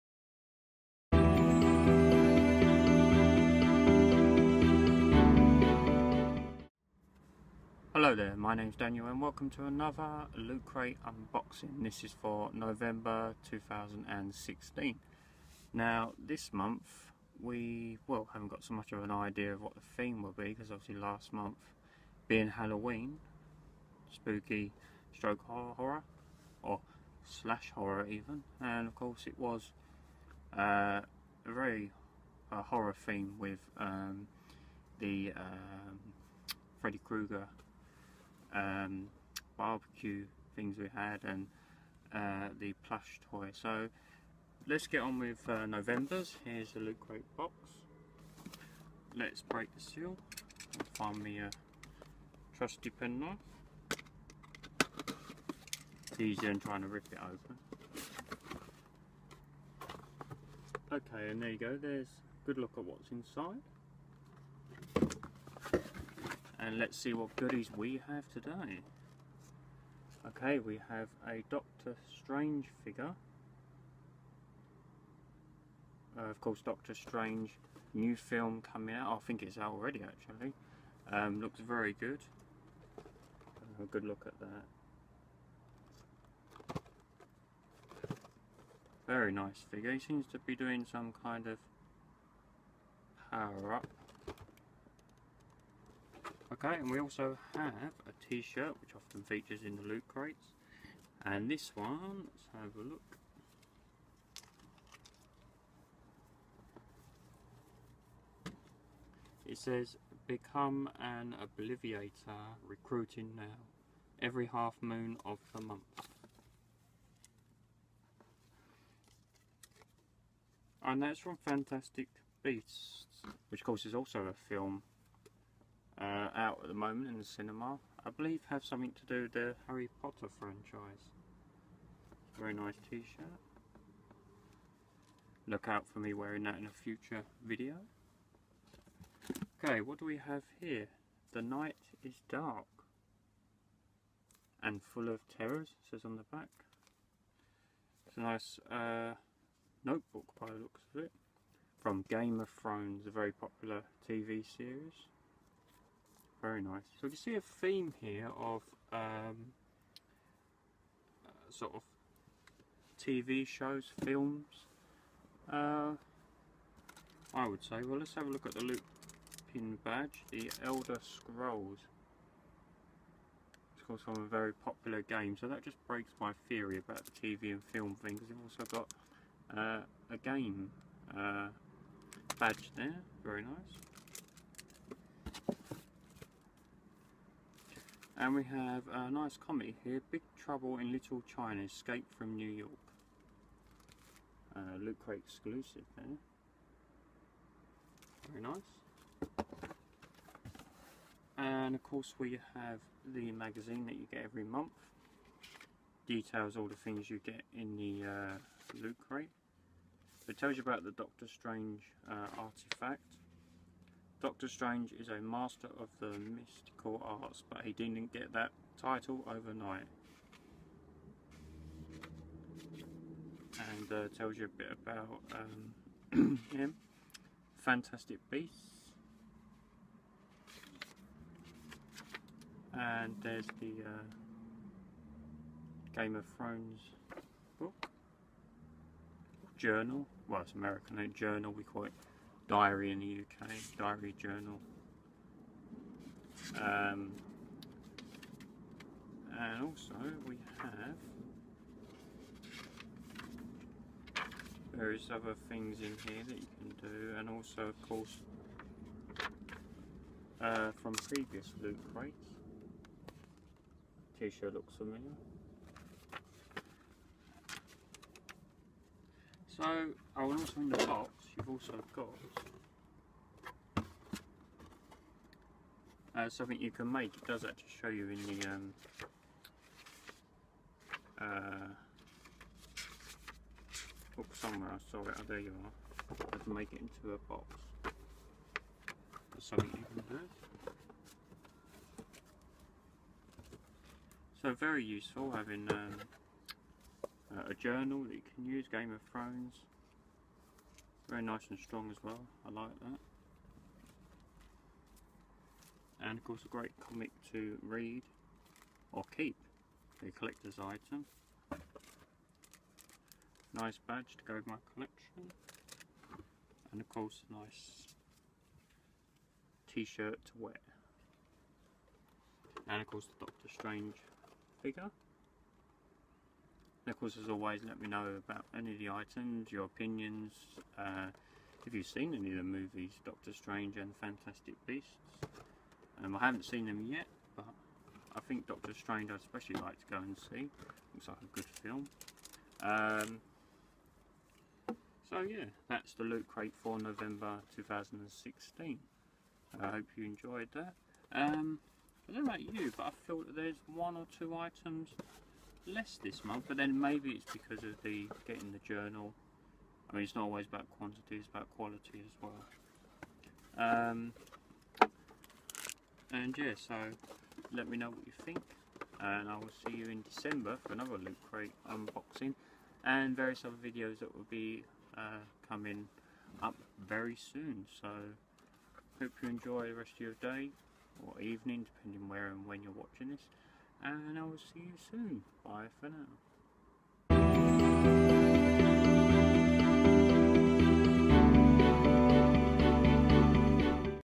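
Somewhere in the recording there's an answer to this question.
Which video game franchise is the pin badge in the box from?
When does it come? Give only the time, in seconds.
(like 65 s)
170 s.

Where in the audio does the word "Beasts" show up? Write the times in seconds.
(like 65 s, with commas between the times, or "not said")
122 s, 228 s, 334 s.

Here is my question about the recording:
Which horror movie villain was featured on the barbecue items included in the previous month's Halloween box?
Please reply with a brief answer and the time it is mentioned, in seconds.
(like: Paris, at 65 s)
Freddy Krueger, at 36 s.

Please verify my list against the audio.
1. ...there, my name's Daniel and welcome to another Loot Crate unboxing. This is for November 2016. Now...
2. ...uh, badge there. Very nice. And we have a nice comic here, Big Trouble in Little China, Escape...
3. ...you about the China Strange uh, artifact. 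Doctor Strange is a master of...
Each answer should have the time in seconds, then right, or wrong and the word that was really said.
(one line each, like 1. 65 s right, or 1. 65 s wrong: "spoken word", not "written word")
1. 8 s right
2. 181 s right
3. 210 s wrong: "Doctor", not "China".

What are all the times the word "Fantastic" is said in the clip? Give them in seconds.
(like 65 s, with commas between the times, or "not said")
121 s, 227 s, 334 s.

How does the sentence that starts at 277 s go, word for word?
It does actually show you in the um, uh, book somewhere.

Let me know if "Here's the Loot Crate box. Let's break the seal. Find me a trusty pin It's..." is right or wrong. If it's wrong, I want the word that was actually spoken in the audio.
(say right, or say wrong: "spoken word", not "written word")
right.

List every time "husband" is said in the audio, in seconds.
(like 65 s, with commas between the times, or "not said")
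not said.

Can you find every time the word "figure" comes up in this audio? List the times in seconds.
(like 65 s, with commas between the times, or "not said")
72 s, 89 s, 324 s.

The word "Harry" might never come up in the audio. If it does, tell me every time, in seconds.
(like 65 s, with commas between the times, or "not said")
129 s.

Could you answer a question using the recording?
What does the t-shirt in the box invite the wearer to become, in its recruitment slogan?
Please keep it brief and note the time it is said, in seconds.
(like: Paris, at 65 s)
An Obliviator, at 111 s.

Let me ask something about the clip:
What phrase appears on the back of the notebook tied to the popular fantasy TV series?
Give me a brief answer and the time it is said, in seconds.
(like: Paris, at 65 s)
The night is dark and full of terrors, at 141 s.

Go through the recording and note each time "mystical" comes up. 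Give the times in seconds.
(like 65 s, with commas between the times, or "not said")
216 s.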